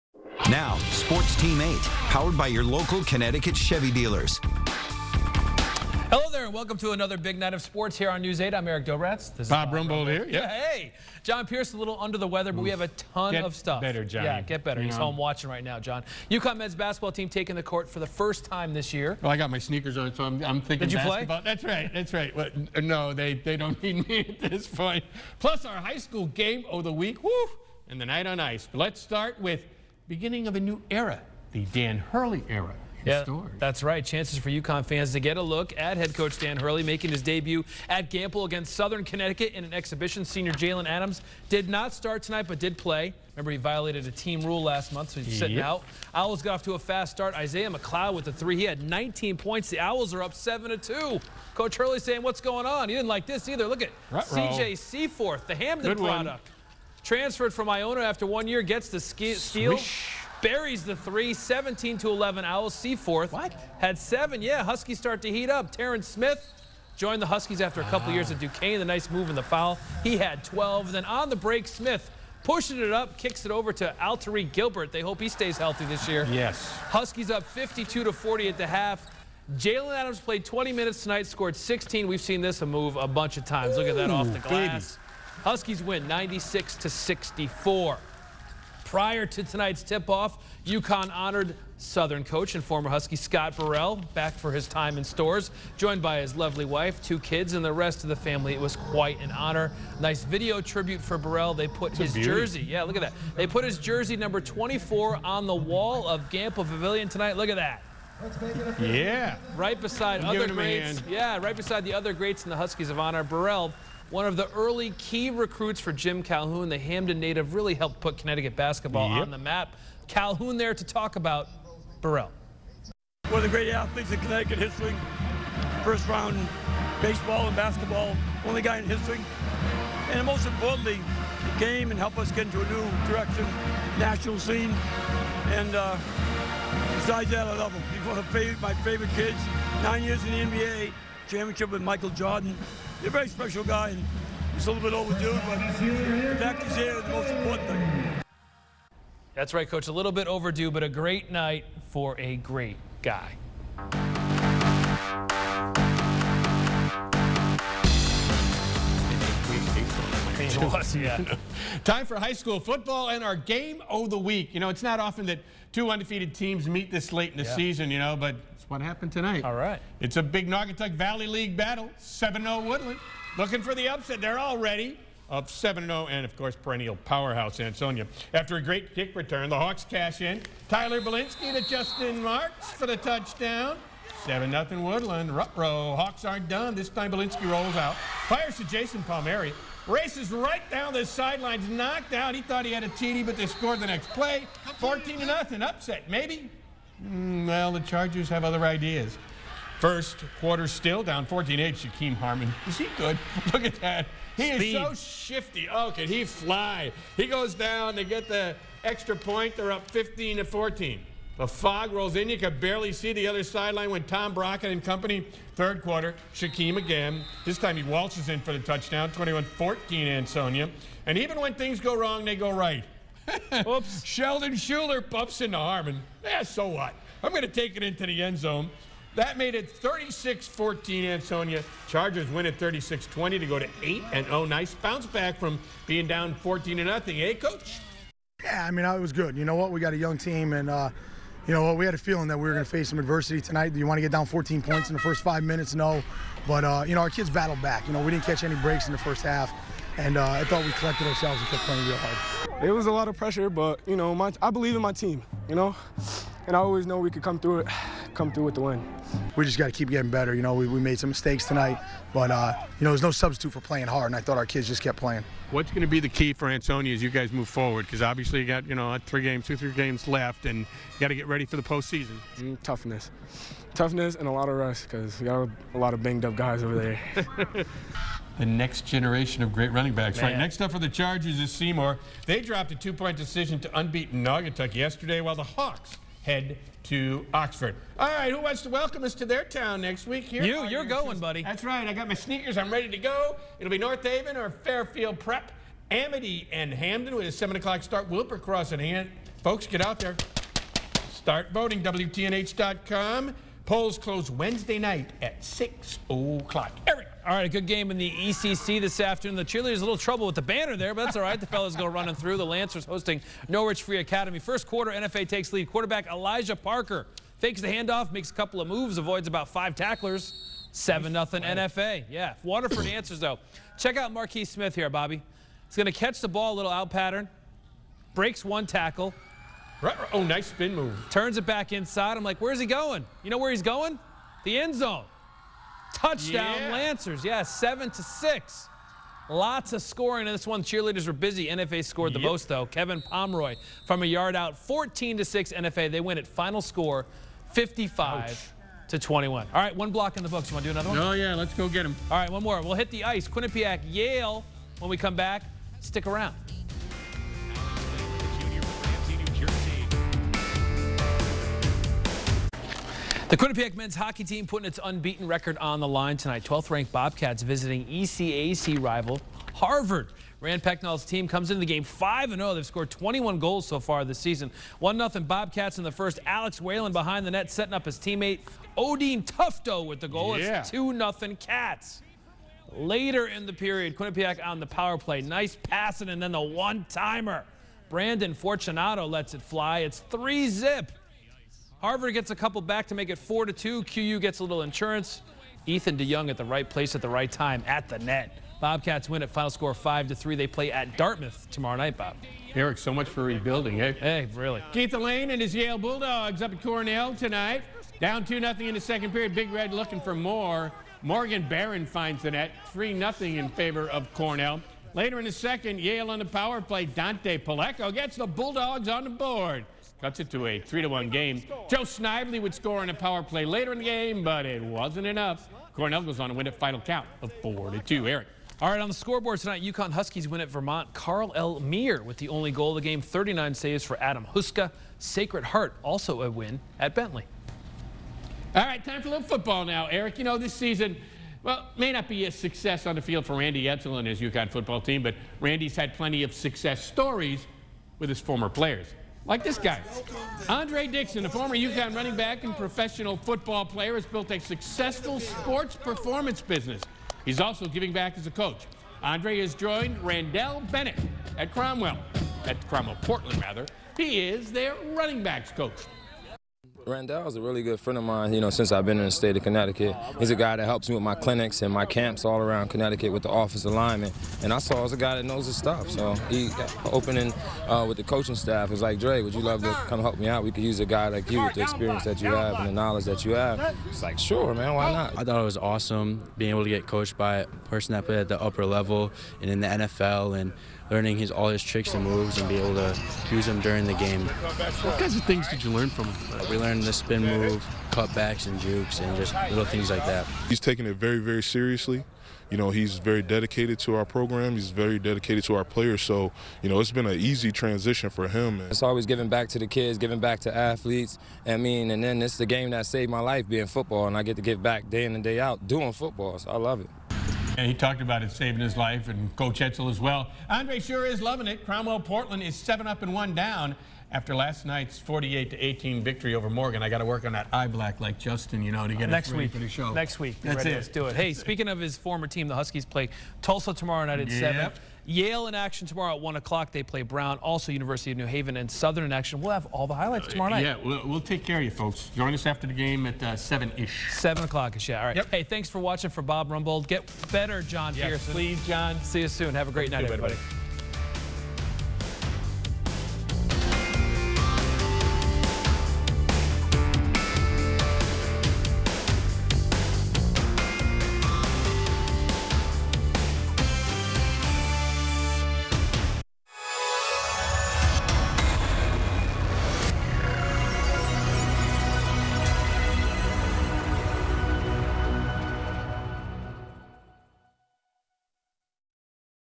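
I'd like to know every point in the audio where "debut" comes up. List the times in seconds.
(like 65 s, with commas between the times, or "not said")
37 s.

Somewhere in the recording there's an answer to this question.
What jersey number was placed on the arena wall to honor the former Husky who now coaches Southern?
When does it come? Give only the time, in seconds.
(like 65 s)
104 s.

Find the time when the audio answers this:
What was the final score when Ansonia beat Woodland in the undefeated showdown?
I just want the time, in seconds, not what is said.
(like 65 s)
232 s.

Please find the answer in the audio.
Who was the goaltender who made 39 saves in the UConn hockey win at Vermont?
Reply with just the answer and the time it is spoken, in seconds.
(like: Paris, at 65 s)
Adam Huska, at 434 s.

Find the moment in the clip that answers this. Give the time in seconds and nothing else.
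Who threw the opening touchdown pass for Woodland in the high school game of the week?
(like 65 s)
180 s.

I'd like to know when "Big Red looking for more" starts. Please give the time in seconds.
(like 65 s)
409 s.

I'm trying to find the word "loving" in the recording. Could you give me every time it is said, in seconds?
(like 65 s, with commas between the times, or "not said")
521 s.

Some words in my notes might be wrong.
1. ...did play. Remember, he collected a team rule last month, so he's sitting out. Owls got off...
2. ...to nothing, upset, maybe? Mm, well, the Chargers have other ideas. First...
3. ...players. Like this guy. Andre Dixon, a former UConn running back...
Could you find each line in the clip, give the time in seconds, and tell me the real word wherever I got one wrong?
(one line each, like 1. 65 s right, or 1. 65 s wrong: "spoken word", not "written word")
1. 42 s wrong: "violated", not "collected"
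2. 195 s right
3. 448 s right.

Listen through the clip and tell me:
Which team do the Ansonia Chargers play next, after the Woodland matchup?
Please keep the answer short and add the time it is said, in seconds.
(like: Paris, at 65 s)
Seymour, at 281 s.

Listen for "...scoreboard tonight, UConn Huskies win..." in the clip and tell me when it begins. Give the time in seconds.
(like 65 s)
428 s.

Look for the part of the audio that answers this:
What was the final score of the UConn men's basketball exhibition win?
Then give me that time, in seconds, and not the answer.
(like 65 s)
86 s.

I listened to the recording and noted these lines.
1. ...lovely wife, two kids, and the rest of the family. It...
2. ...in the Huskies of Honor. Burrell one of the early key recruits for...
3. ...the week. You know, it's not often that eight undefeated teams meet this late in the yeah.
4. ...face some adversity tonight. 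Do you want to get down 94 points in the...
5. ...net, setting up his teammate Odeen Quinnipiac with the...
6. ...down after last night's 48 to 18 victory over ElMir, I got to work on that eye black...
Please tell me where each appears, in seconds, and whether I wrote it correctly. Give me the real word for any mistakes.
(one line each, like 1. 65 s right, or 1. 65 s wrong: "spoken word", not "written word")
1. 96 s right
2. 112 s right
3. 164 s wrong: "two", not "eight"
4. 242 s wrong: "14", not "94"
5. 377 s wrong: "Tufto", not "Quinnipiac"
6. 523 s wrong: "Morgan", not "ElMir".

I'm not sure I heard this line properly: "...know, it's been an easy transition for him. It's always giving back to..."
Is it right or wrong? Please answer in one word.
right.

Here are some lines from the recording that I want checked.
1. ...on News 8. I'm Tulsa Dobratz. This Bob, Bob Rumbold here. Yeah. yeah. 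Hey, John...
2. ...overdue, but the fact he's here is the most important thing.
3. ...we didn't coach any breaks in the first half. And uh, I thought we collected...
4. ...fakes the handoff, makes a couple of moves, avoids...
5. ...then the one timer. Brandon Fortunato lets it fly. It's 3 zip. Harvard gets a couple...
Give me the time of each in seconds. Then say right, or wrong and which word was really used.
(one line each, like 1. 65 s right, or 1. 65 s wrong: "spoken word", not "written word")
1. 8 s wrong: "Eric", not "Tulsa"
2. 144 s right
3. 248 s wrong: "catch", not "coach"
4. 317 s right
5. 386 s right.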